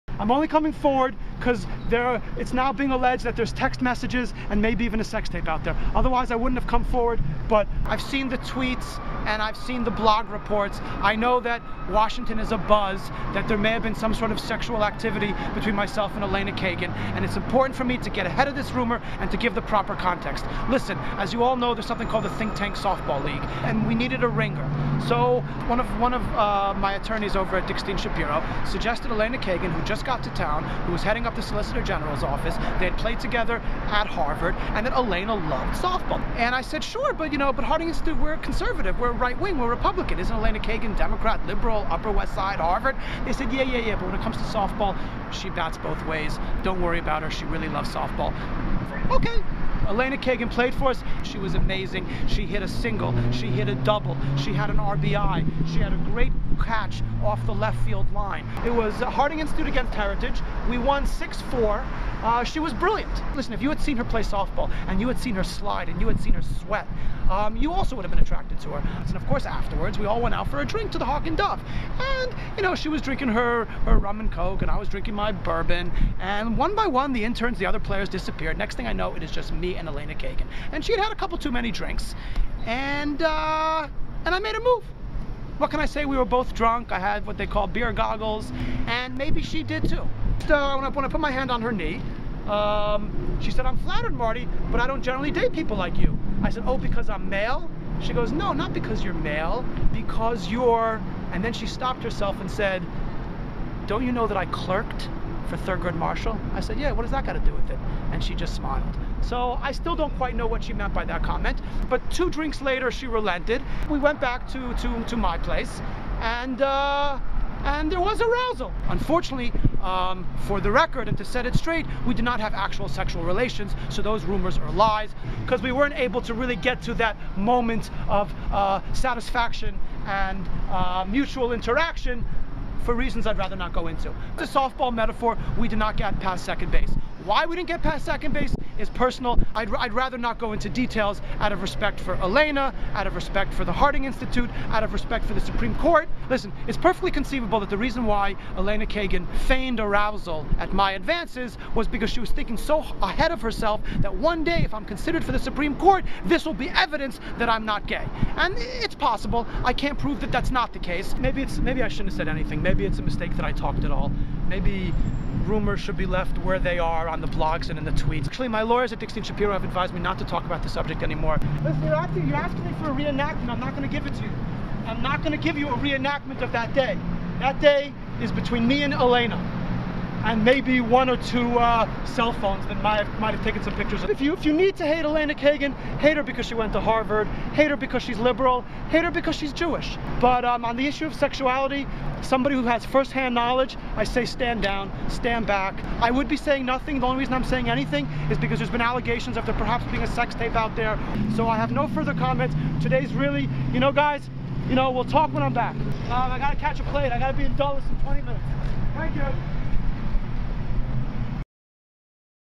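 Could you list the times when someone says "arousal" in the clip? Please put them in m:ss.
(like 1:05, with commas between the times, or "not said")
1:58, 2:29.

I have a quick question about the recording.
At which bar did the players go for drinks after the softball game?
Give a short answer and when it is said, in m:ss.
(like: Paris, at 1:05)
the Hawk and Dove, at 1:10.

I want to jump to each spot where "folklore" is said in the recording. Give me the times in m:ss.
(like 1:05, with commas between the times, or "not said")
not said.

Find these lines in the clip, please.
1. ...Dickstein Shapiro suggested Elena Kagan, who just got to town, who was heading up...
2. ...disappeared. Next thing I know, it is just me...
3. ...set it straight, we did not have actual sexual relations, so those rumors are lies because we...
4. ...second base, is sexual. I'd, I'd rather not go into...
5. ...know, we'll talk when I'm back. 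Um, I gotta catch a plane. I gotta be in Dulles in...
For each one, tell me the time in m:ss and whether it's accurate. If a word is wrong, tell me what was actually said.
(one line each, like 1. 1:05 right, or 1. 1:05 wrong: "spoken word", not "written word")
1. 0:27 right
2. 1:18 right
3. 2:01 right
4. 2:18 wrong: "personal", not "sexual"
5. 3:24 right.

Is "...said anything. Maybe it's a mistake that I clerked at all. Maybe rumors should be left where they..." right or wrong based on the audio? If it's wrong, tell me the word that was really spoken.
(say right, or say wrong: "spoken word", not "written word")
wrong: "talked", not "clerked".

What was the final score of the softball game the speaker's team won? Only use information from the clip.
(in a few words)
6-4.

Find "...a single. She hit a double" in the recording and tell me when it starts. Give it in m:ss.
0:52.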